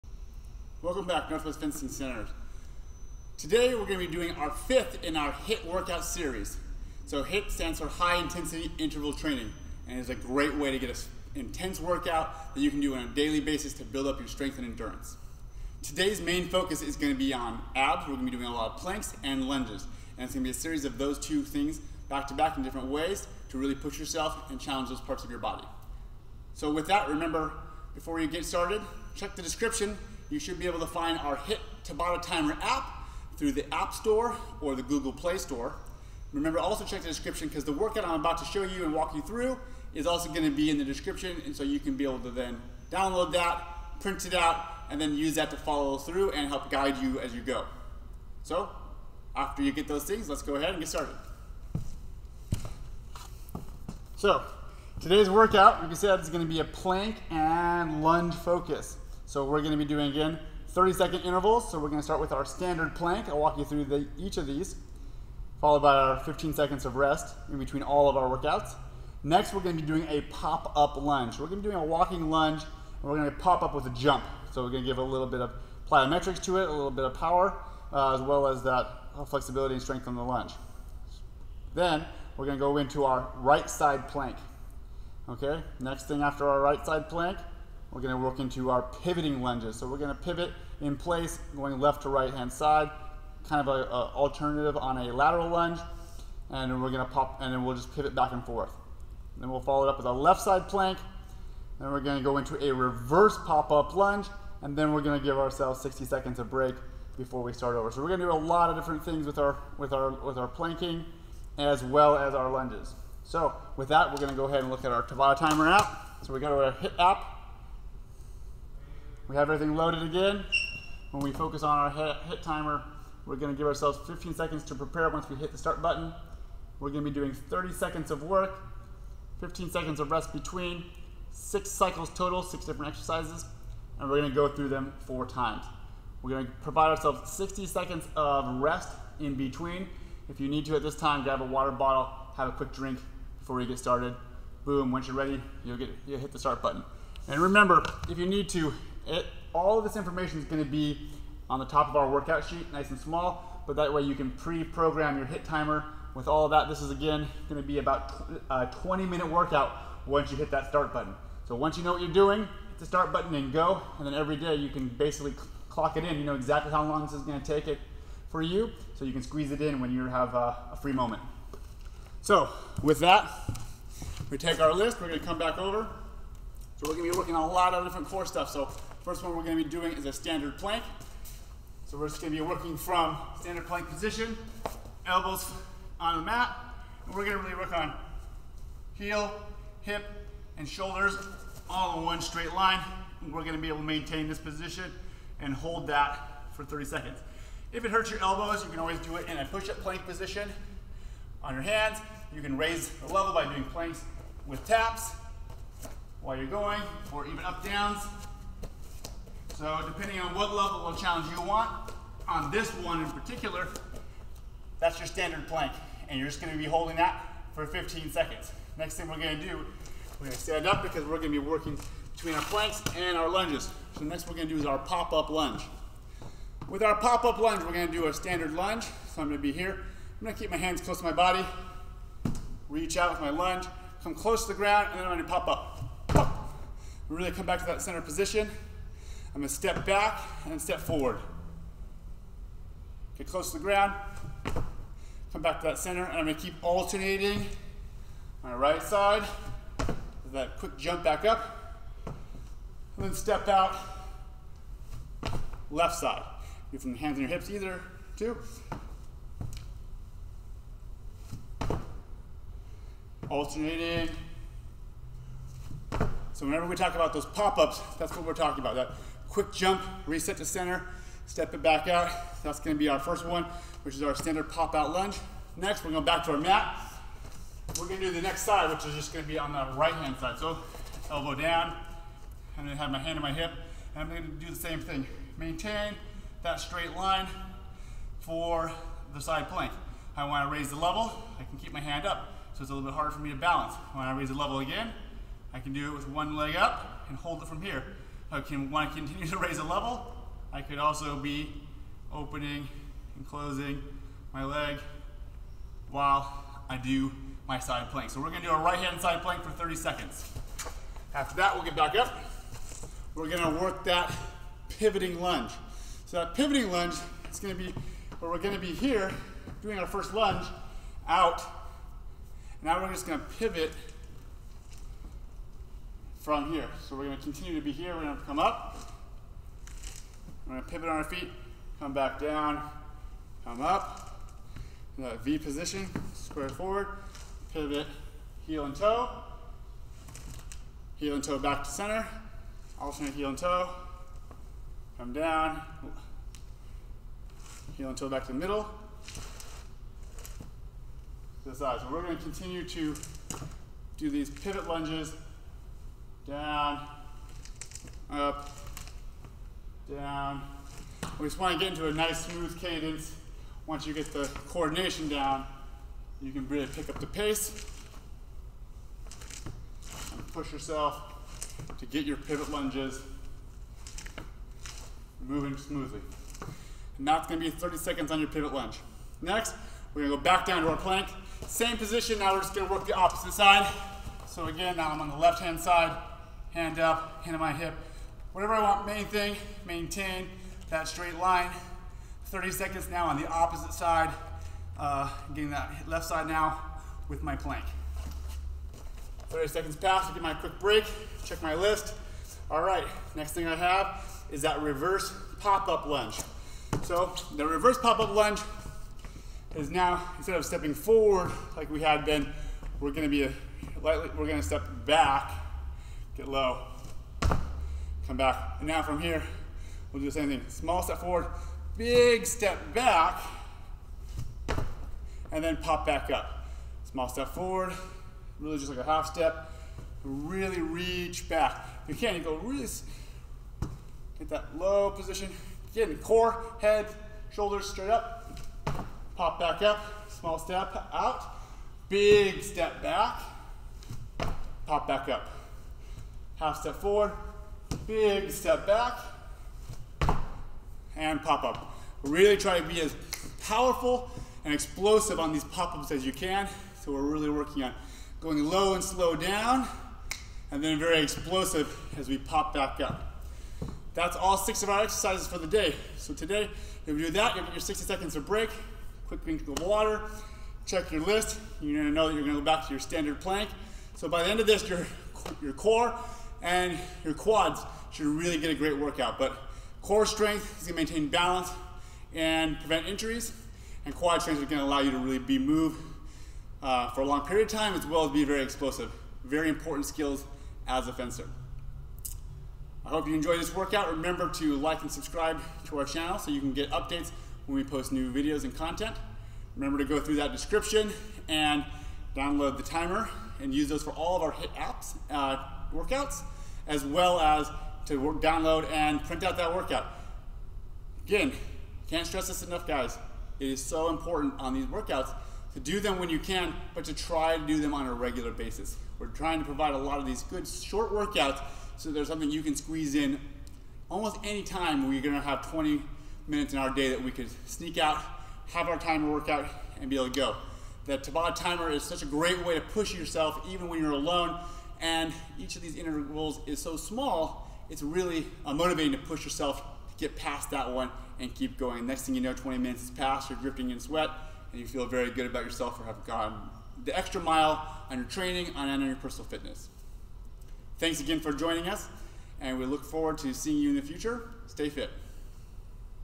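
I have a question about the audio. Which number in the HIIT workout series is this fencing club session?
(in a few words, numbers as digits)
fifth.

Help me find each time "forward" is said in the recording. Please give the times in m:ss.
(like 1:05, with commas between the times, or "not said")
4:00, 5:36, 6:50, 7:00, 7:07, 7:26, 9:12.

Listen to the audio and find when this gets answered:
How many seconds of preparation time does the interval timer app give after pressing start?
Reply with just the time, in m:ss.
2:04.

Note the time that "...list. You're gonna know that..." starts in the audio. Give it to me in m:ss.
7:51.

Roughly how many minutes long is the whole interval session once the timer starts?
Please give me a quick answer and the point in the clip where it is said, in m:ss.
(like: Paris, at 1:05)
20, at 2:38.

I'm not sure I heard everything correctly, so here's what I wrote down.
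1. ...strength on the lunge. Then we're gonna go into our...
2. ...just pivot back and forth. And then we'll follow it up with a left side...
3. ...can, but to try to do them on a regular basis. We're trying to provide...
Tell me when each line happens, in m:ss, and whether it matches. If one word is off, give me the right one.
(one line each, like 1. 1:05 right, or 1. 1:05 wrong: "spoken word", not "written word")
1. 1:19 right
2. 1:37 right
3. 8:36 right.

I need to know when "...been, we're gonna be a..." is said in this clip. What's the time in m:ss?
6:52.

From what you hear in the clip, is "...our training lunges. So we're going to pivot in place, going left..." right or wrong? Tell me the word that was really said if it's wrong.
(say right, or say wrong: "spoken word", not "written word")
wrong: "pivoting", not "training".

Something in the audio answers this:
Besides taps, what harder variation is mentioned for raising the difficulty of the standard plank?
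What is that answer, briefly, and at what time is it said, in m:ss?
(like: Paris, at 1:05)
up-downs, at 3:27.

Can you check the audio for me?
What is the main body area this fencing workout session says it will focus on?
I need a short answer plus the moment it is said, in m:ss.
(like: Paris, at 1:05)
abs, at 0:17.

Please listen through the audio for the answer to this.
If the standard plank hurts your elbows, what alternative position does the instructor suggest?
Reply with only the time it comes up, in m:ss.
3:19.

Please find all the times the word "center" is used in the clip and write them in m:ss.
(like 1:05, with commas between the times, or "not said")
0:01, 3:57, 4:05, 4:30, 5:41.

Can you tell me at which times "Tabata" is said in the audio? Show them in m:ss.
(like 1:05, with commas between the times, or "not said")
0:31, 1:55, 8:50.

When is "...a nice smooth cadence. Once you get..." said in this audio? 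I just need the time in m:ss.
6:01.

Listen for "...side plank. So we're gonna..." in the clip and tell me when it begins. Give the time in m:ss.
5:07.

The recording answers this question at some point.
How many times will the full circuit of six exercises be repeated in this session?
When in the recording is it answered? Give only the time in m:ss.
2:15.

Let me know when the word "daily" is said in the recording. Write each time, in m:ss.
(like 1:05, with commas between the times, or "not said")
0:13.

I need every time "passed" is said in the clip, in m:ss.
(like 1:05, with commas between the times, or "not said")
6:39, 9:02.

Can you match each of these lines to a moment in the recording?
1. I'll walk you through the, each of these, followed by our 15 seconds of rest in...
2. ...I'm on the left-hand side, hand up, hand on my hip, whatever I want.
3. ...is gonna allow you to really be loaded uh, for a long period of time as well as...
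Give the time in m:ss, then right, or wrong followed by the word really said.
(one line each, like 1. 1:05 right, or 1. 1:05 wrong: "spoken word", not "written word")
1. 1:03 right
2. 6:24 right
3. 8:04 wrong: "moved", not "loaded".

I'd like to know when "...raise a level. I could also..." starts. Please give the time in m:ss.
4:59.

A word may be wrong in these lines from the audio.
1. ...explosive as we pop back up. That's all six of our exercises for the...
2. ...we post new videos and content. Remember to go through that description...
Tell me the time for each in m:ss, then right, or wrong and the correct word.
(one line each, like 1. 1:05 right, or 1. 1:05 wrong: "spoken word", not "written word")
1. 7:41 right
2. 8:17 right.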